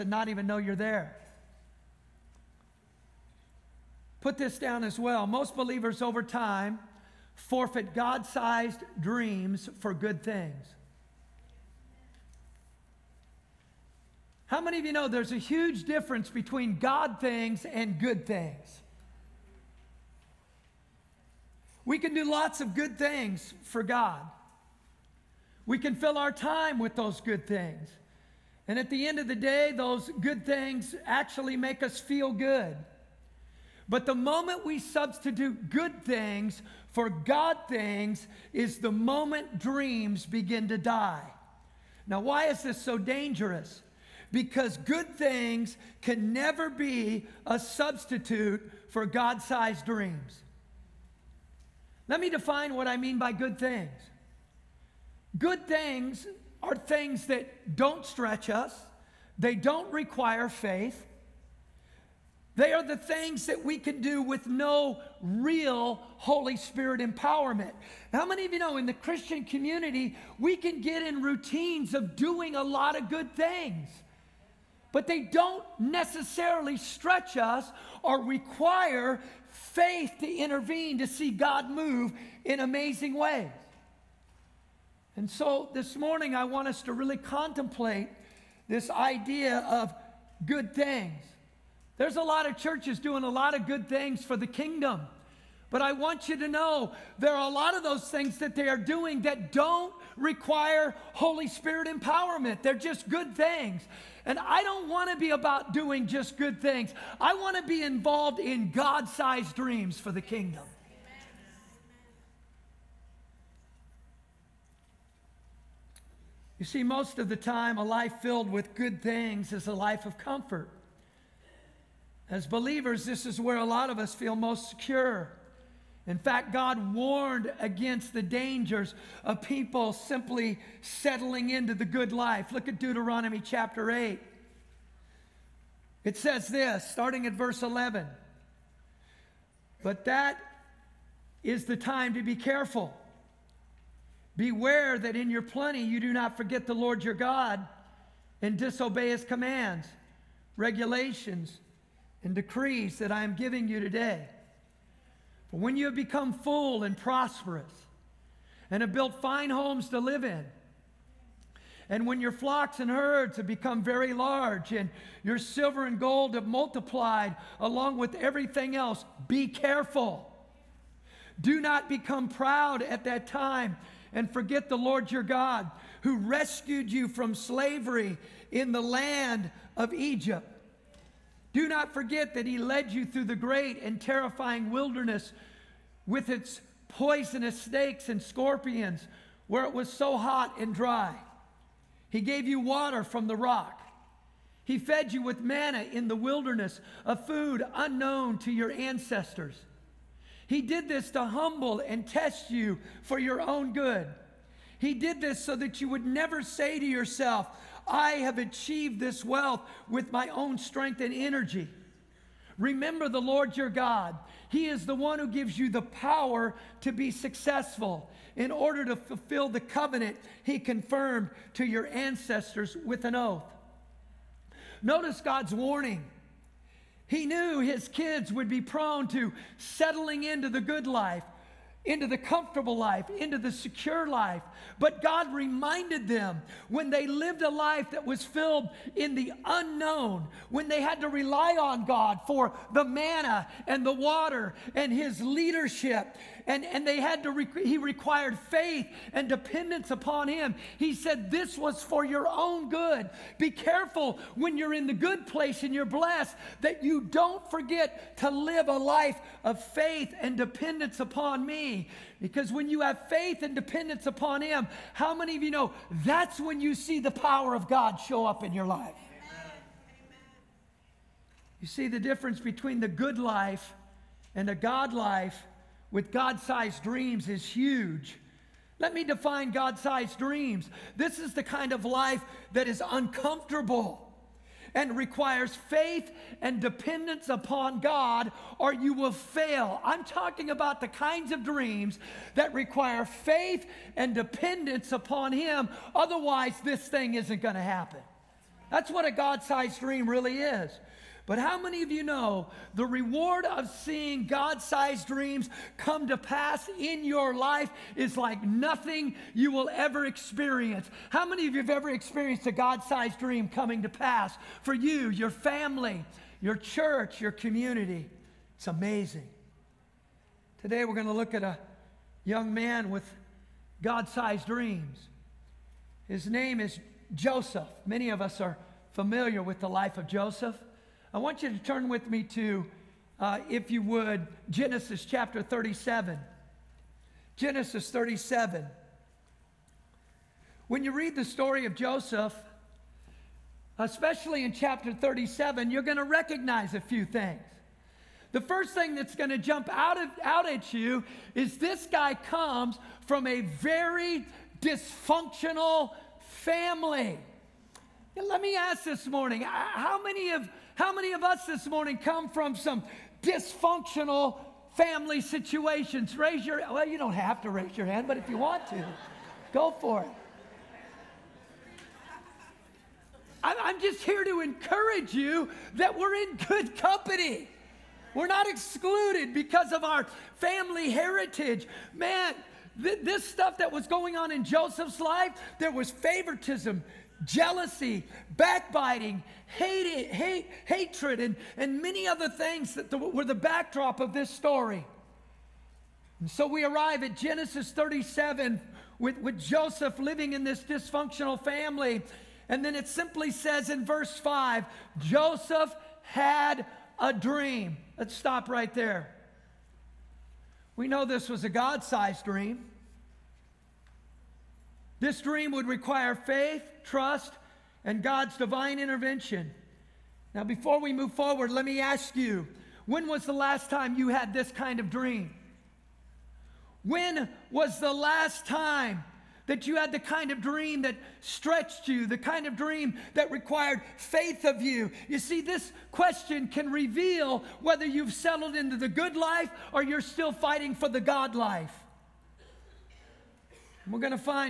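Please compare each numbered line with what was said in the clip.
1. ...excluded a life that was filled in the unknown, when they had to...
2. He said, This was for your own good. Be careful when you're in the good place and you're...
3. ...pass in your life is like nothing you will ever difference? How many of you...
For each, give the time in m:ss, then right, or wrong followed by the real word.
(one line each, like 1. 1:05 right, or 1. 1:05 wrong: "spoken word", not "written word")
1. 3:57 wrong: "lived", not "excluded"
2. 4:10 right
3. 5:06 wrong: "experience", not "difference".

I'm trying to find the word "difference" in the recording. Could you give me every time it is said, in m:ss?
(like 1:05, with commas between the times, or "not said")
0:15, 4:31.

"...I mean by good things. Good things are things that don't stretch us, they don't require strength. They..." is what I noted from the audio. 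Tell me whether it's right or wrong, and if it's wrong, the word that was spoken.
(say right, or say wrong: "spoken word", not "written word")
wrong: "faith", not "strength".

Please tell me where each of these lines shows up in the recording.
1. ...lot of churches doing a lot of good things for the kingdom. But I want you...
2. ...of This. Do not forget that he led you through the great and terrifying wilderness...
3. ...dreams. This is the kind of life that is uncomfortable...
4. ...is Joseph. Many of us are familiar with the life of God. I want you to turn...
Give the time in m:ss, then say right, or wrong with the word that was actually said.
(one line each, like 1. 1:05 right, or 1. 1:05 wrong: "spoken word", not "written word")
1. 1:32 right
2. 2:59 wrong: "Egypt", not "This"
3. 4:40 right
4. 5:26 wrong: "Joseph", not "God".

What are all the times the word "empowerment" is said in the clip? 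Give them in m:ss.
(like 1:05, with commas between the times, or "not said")
1:06, 1:41.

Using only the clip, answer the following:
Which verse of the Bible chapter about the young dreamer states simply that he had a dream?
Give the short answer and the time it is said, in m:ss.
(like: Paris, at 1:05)
Verse 5, at 6:43.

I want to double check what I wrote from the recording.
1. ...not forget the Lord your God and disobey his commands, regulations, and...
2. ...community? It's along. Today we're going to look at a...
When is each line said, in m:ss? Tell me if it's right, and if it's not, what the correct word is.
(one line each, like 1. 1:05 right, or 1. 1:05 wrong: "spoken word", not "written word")
1. 2:26 right
2. 5:17 wrong: "amazing", not "along".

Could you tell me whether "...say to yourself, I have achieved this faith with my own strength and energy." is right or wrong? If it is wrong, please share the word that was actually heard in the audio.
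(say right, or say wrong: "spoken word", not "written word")
wrong: "wealth", not "faith".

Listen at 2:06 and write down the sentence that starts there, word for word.
In fact, God warned against the dangers of people simply settling into the good life.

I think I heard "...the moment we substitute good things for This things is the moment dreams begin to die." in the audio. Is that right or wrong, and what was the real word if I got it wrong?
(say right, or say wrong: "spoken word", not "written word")
wrong: "God", not "This".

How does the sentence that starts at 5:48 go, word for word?
The first thing that's going to jump out, of, out at you is this guy comes from a very dysfunctional family.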